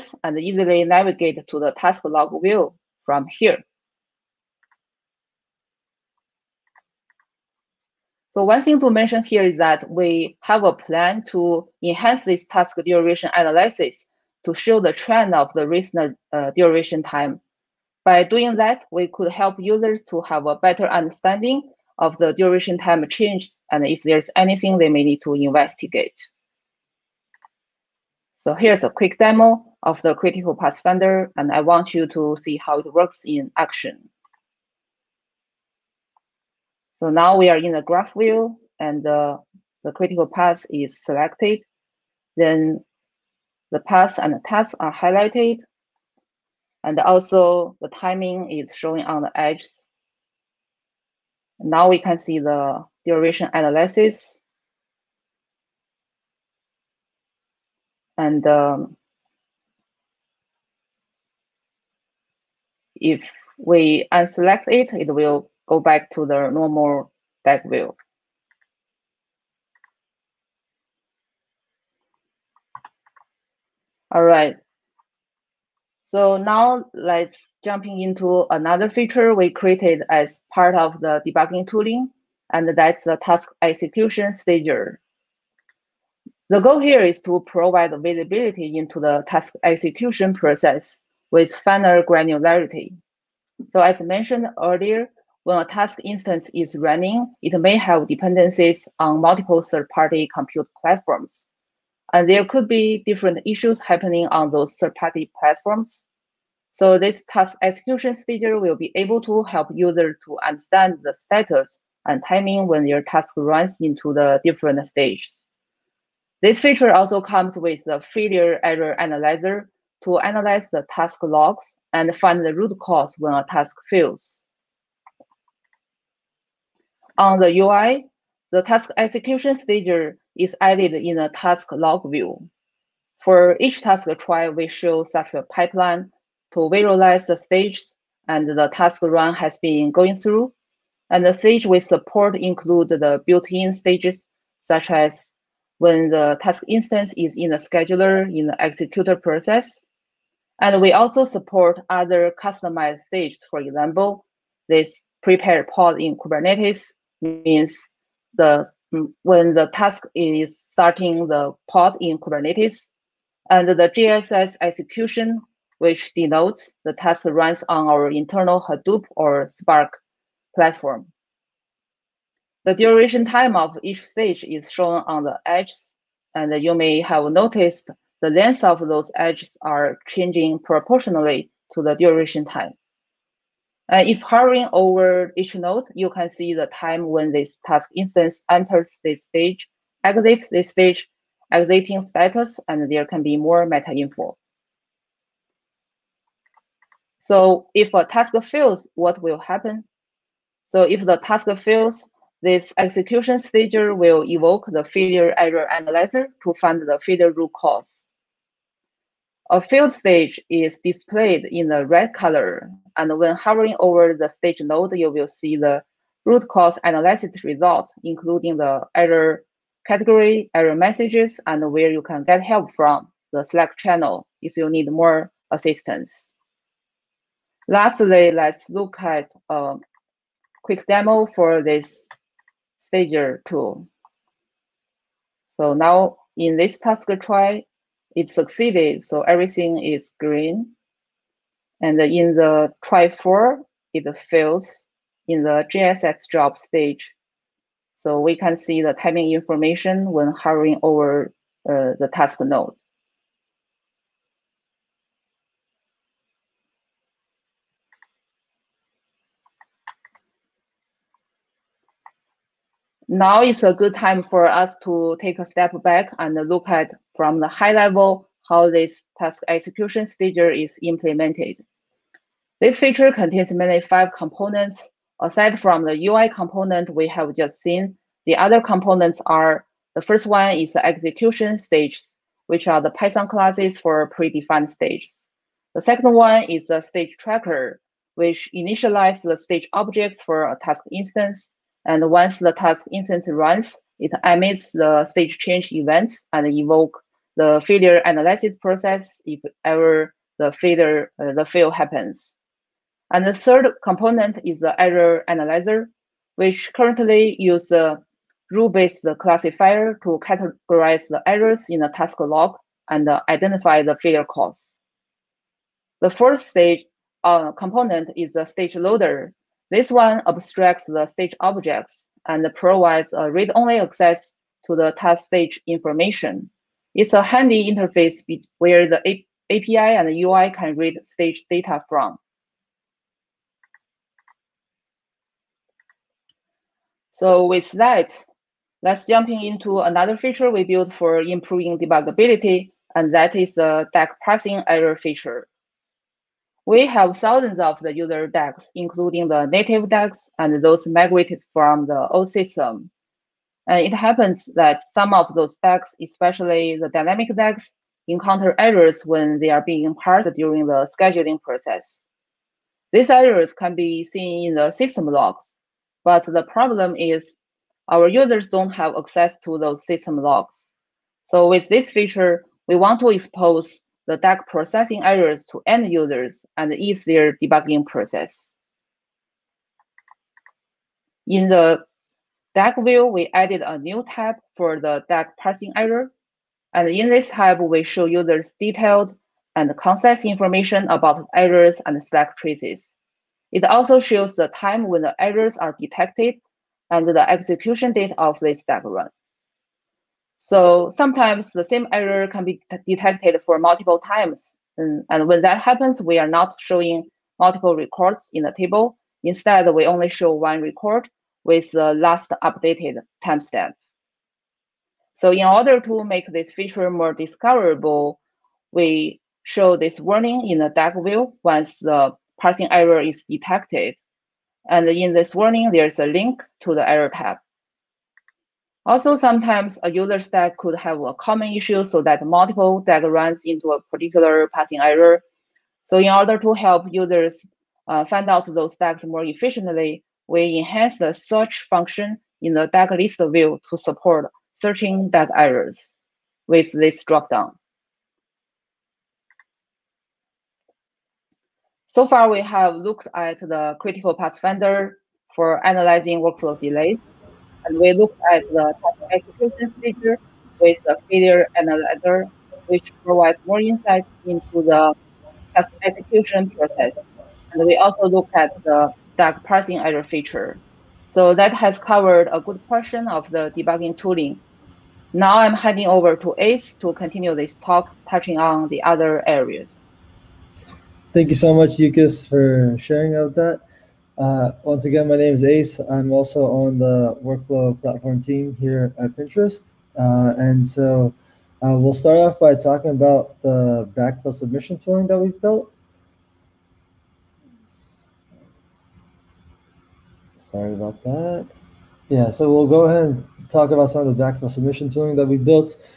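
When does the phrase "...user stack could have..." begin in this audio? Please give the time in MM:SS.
07:09.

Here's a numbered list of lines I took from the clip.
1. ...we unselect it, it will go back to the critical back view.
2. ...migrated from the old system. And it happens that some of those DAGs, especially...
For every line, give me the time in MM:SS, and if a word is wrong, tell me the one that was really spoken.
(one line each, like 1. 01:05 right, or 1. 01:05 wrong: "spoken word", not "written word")
1. 01:03 wrong: "normal", not "critical"
2. 05:50 right.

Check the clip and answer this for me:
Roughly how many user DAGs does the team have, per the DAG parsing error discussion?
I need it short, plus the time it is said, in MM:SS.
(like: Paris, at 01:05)
Thousands, at 05:47.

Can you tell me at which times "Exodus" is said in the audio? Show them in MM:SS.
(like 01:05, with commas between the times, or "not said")
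not said.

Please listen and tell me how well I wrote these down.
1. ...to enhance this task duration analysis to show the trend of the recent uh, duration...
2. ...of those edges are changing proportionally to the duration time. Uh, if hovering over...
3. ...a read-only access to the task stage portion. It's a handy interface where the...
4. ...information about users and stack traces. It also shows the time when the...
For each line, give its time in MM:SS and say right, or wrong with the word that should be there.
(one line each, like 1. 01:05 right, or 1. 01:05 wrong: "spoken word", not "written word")
1. 00:11 right
2. 02:58 right
3. 05:23 wrong: "information", not "portion"
4. 06:30 wrong: "errors", not "users".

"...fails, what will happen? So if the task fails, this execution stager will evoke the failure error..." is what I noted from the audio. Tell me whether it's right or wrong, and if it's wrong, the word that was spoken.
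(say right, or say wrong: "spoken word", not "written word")
right.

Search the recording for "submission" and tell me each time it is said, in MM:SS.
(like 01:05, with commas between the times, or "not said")
08:14, 08:24.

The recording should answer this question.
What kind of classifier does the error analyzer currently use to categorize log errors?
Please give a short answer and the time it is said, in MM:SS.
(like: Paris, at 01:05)
Rule-based classifier, at 05:08.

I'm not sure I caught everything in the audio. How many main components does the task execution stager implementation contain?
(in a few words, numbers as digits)
5.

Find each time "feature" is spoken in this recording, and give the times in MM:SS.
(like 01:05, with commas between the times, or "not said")
01:18, 01:56, 04:32, 05:40, 05:44, 06:11, 06:56, 07:50.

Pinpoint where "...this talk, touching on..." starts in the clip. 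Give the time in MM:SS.
07:57.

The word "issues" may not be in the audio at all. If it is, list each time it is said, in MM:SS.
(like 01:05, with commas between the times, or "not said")
01:43, 07:11.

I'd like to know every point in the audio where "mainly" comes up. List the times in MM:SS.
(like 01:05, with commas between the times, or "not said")
04:33.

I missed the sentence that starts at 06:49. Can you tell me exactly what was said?
Instead, we only show one record with the last updated timestamp.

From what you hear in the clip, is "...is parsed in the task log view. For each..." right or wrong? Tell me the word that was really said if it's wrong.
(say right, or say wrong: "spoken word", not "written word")
wrong: "added", not "parsed".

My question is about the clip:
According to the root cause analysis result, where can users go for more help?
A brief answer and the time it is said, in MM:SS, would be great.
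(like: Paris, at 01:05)
The Slack channel, at 03:43.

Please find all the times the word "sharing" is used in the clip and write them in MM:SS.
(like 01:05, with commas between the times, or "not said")
08:02.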